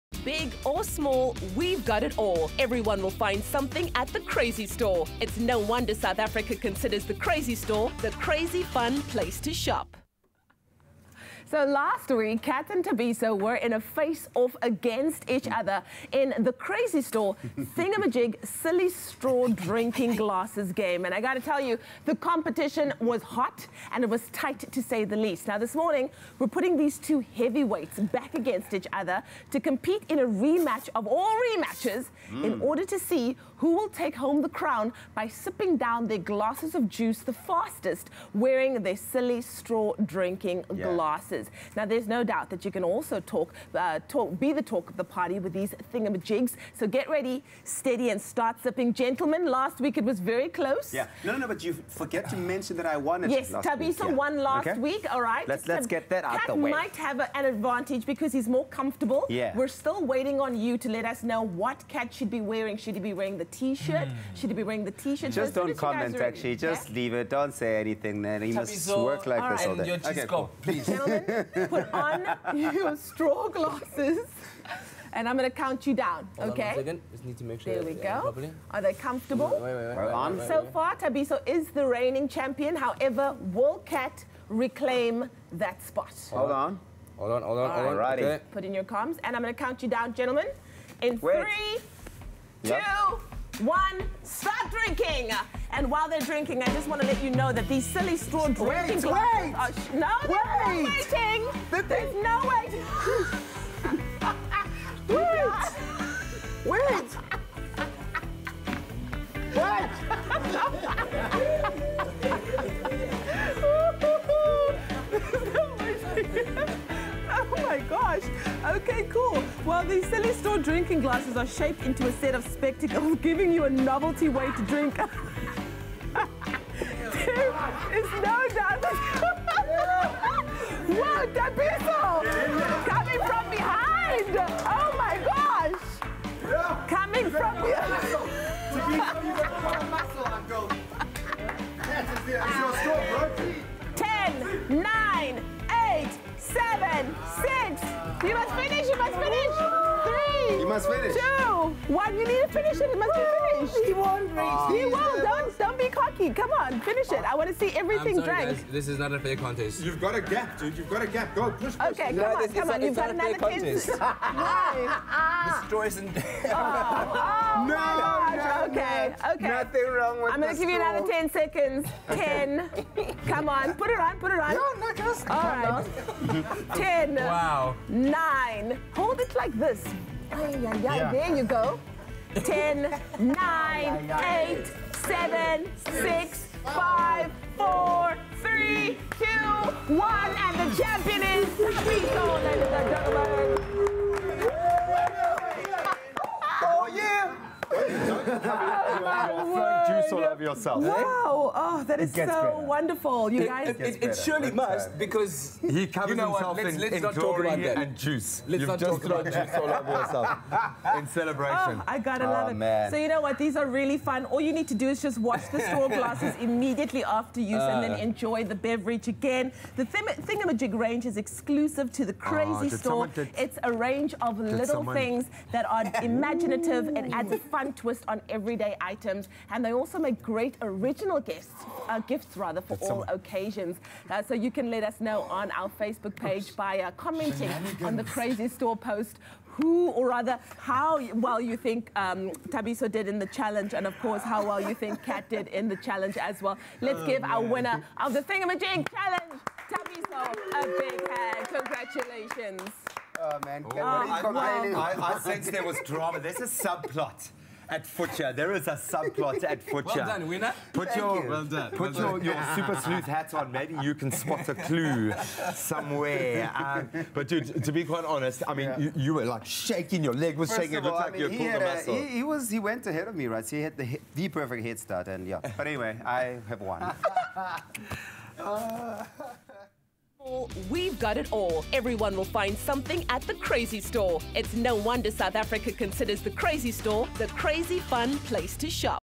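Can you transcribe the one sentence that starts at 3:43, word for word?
It's a range of little someone...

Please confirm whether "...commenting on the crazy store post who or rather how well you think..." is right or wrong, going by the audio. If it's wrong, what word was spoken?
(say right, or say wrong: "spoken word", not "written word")
right.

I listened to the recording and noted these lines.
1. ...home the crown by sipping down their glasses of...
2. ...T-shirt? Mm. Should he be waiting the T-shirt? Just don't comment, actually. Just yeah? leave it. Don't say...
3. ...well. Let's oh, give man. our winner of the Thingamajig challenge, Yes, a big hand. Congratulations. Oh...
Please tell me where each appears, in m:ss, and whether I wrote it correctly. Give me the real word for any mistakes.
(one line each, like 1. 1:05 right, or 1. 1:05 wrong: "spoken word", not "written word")
1. 0:34 right
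2. 1:03 wrong: "wearing", not "waiting"
3. 4:06 wrong: "Thabiso", not "Yes".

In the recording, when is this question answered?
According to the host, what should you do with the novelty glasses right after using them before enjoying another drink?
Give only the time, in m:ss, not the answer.
3:35.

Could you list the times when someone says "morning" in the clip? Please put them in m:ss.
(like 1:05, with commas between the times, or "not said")
0:25.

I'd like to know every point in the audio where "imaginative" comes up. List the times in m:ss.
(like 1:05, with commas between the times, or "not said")
3:46.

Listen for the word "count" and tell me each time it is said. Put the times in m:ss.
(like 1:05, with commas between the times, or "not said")
1:15, 1:29.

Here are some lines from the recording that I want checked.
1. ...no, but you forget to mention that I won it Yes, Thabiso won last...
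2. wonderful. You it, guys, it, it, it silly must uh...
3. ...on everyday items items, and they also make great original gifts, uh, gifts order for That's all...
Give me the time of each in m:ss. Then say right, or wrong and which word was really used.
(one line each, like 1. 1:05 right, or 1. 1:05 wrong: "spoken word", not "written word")
1. 0:51 right
2. 3:22 wrong: "surely", not "silly"
3. 3:48 wrong: "rather", not "order".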